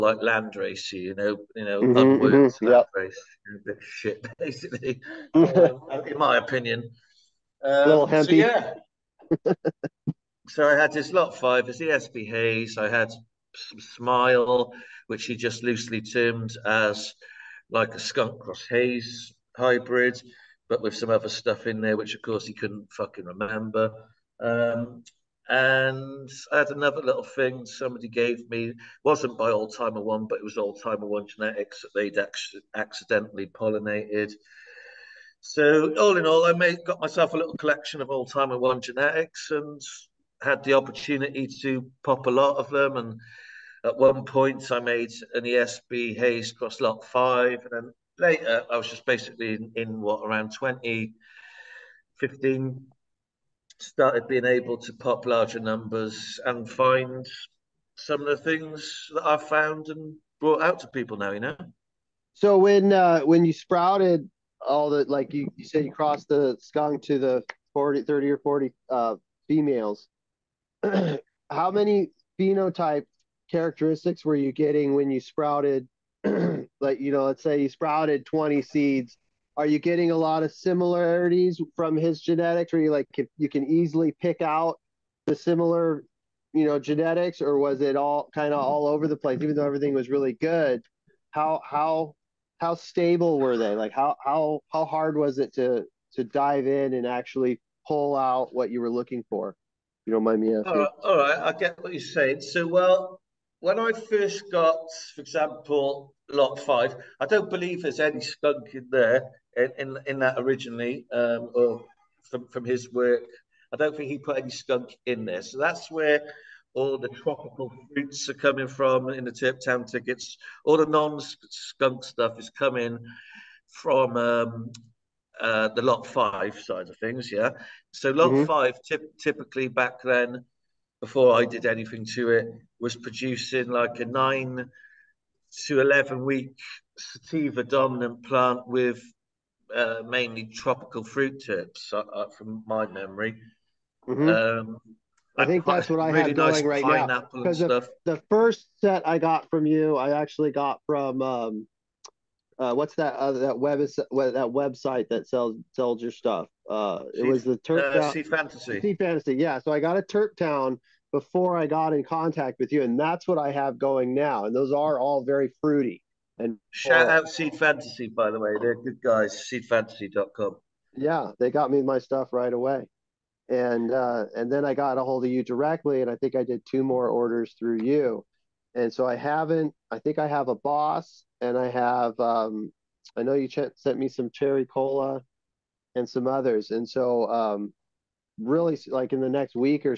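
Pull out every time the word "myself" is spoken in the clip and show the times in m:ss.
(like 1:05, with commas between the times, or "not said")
0:37.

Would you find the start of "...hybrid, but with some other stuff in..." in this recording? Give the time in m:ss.
0:19.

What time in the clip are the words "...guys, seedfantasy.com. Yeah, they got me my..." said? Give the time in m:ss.
2:48.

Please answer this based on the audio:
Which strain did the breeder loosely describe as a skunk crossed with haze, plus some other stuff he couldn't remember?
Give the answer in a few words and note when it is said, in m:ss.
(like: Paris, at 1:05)
Smile, at 0:13.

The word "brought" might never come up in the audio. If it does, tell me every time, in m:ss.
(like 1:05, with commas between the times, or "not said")
1:00.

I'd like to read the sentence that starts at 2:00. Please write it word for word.
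All the non-skunk stuff is coming from um, uh, the lot five side of things, yeah.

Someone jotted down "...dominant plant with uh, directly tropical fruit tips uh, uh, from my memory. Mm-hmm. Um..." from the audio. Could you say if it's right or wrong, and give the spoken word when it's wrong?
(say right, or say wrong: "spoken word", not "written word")
wrong: "mainly", not "directly".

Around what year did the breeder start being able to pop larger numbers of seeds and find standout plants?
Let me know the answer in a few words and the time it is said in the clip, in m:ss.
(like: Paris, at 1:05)
2015, at 0:50.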